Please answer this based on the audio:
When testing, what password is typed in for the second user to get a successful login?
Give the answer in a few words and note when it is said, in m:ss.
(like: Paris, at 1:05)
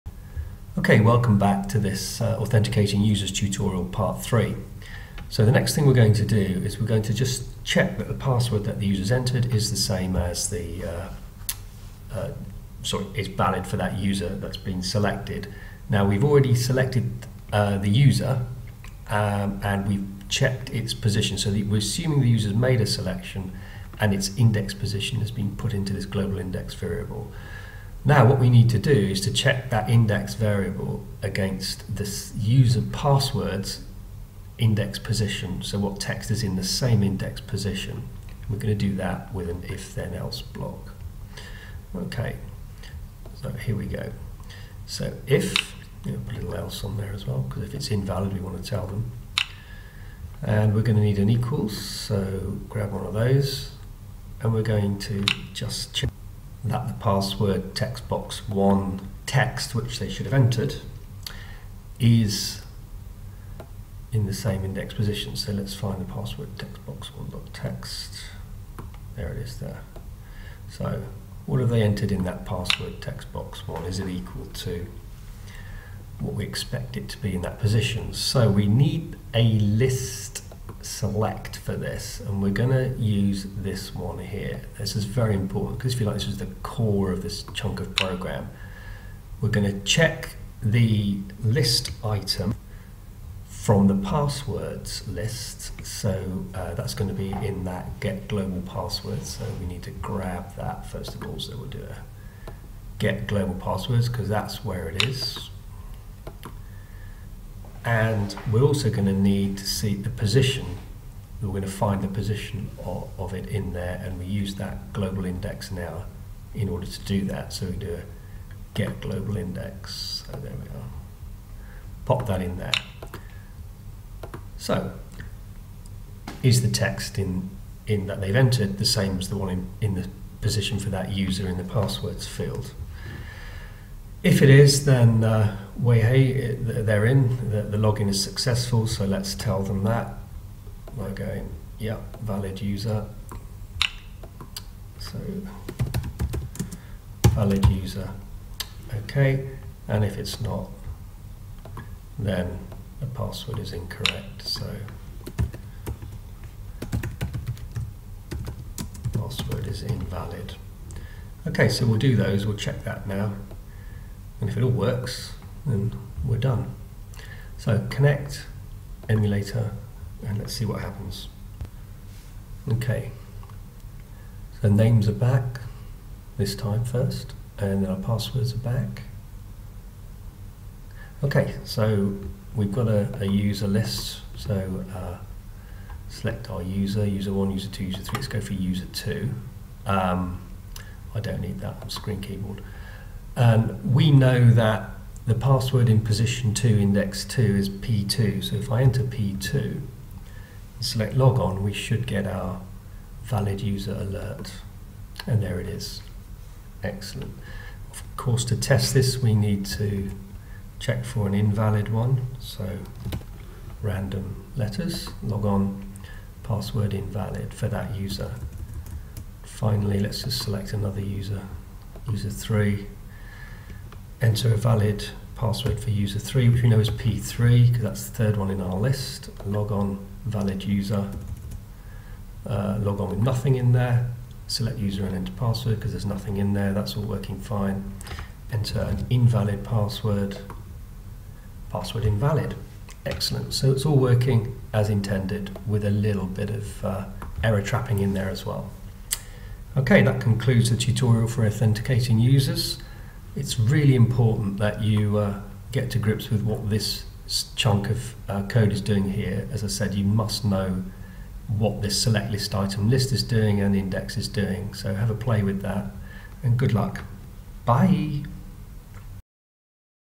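P2, at 3:19.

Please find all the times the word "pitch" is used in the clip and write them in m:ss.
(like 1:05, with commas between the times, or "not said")
not said.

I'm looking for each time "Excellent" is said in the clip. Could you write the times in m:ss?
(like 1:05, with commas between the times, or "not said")
3:26, 4:03.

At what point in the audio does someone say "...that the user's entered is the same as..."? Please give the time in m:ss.
0:08.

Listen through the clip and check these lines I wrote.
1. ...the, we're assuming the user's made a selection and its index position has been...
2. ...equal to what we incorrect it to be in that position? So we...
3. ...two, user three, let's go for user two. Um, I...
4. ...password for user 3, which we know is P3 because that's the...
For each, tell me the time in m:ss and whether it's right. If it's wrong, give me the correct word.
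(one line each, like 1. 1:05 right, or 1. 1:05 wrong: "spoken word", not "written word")
1. 0:21 right
2. 1:14 wrong: "expect", not "incorrect"
3. 3:07 right
4. 3:45 right.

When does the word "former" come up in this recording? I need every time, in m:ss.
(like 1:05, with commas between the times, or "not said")
not said.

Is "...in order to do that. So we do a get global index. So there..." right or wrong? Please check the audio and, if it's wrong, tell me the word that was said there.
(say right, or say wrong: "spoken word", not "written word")
right.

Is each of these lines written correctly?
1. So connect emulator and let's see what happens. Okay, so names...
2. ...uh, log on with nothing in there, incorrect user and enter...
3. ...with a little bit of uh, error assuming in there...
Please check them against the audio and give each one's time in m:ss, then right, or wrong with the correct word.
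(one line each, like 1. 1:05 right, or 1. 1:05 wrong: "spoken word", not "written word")
1. 2:47 right
2. 3:52 wrong: "select", not "incorrect"
3. 4:05 wrong: "trapping", not "assuming".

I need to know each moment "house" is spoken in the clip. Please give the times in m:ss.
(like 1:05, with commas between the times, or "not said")
not said.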